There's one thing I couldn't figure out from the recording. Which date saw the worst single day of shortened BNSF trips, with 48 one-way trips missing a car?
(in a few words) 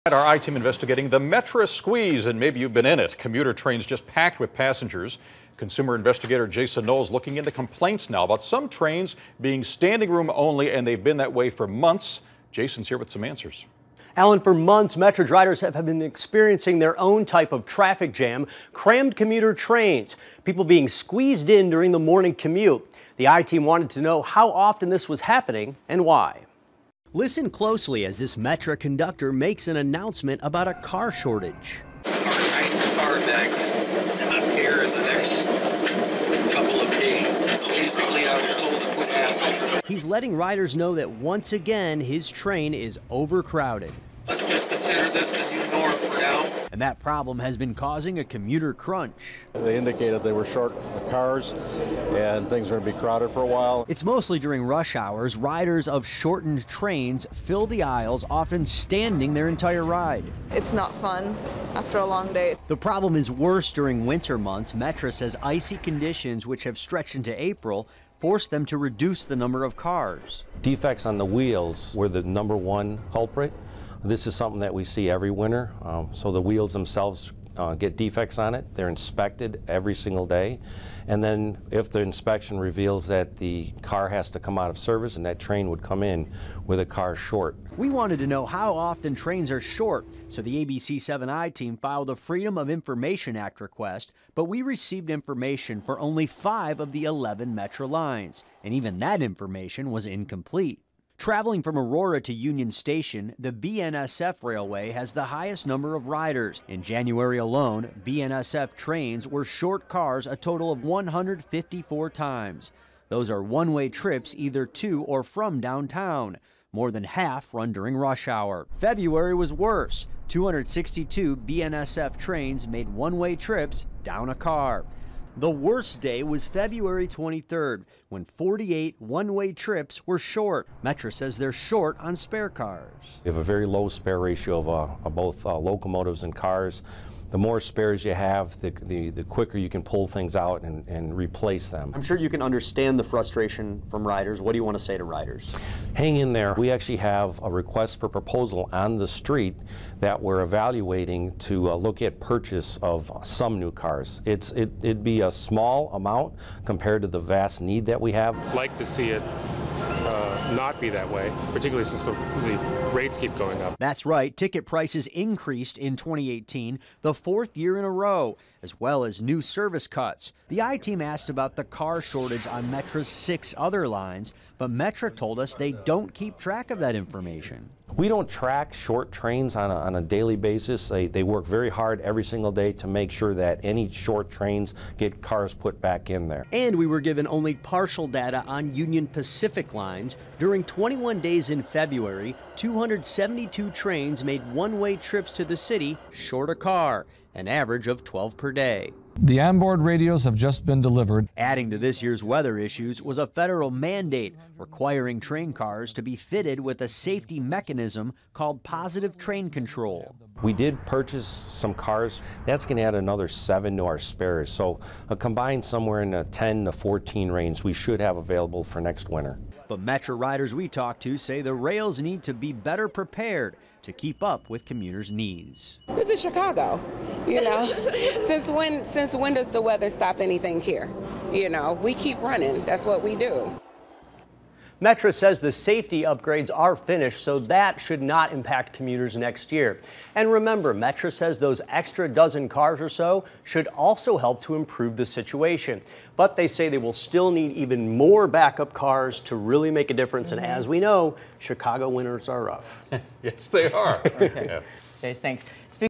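February 23rd.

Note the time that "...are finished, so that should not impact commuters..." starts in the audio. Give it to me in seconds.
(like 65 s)
236 s.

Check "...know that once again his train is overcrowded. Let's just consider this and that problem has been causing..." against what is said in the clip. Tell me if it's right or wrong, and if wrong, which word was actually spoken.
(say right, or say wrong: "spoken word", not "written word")
right.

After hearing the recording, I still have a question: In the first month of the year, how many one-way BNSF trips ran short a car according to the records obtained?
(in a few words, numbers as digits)
154.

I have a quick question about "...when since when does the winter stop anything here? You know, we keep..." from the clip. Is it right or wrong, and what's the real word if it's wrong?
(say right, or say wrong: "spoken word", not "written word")
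wrong: "weather", not "winter".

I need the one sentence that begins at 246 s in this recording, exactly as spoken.
But they say they will still need even more backup cars to really make a difference.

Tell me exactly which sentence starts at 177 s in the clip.
We don't track short trains on a, on a daily basis.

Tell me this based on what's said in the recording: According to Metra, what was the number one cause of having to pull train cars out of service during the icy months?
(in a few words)
Defects on the wheels.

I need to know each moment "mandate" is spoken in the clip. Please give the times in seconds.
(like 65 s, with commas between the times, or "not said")
203 s.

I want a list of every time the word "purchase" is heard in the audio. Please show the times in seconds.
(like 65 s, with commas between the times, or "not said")
152 s, 210 s.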